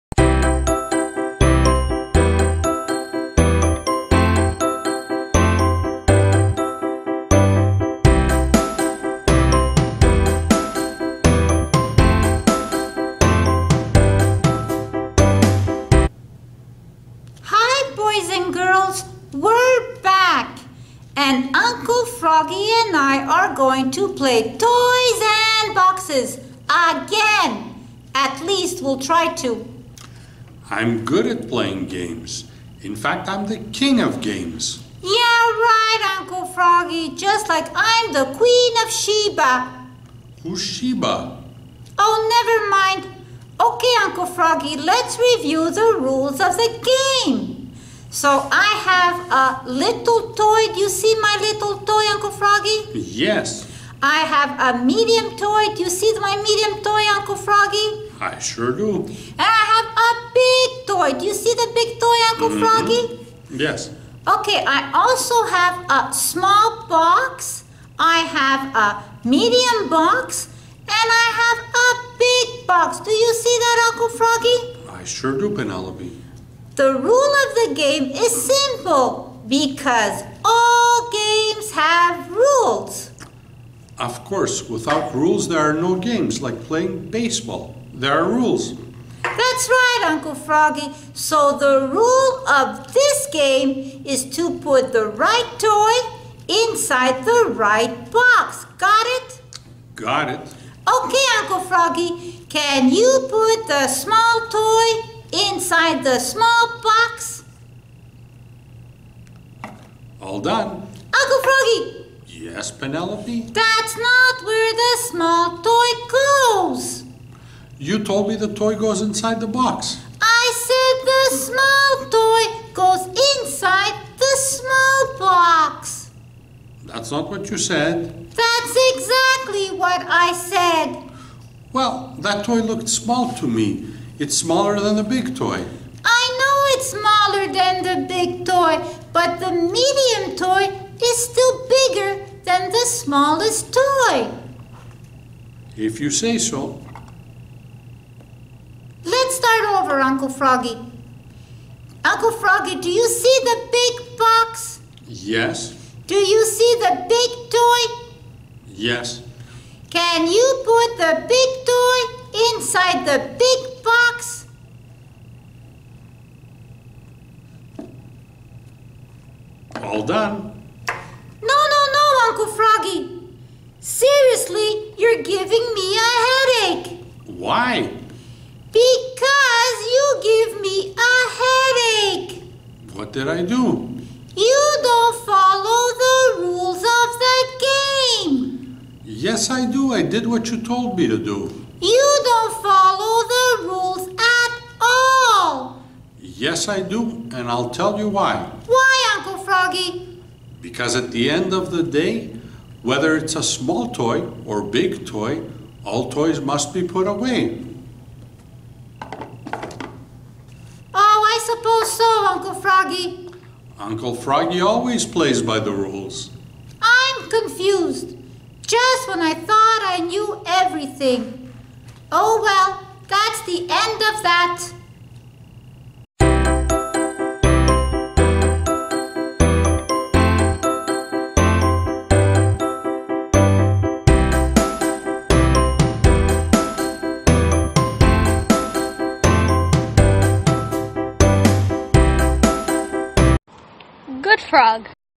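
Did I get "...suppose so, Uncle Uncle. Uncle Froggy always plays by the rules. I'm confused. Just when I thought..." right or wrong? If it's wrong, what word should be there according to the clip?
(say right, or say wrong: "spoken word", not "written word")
wrong: "Froggy", not "Uncle".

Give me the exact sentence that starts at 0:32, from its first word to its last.
In fact, I'm the king of games.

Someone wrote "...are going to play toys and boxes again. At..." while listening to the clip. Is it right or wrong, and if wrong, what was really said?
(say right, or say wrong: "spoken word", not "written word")
right.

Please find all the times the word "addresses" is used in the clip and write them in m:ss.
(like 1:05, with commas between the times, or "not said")
not said.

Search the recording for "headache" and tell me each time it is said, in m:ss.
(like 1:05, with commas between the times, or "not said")
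2:56, 3:01.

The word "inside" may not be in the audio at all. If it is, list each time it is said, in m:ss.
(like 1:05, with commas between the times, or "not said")
1:36, 1:45, 1:59, 2:03.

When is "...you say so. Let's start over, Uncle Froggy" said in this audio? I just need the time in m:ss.
2:25.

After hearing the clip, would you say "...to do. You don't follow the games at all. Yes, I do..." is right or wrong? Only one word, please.
wrong.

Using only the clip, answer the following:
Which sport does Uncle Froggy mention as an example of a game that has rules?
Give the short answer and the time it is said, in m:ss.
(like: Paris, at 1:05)
Baseball, at 1:27.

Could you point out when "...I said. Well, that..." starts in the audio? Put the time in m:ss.
2:10.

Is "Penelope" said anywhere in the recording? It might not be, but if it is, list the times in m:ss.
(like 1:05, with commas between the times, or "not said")
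1:15, 1:52.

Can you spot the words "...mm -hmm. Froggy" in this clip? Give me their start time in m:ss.
1:02.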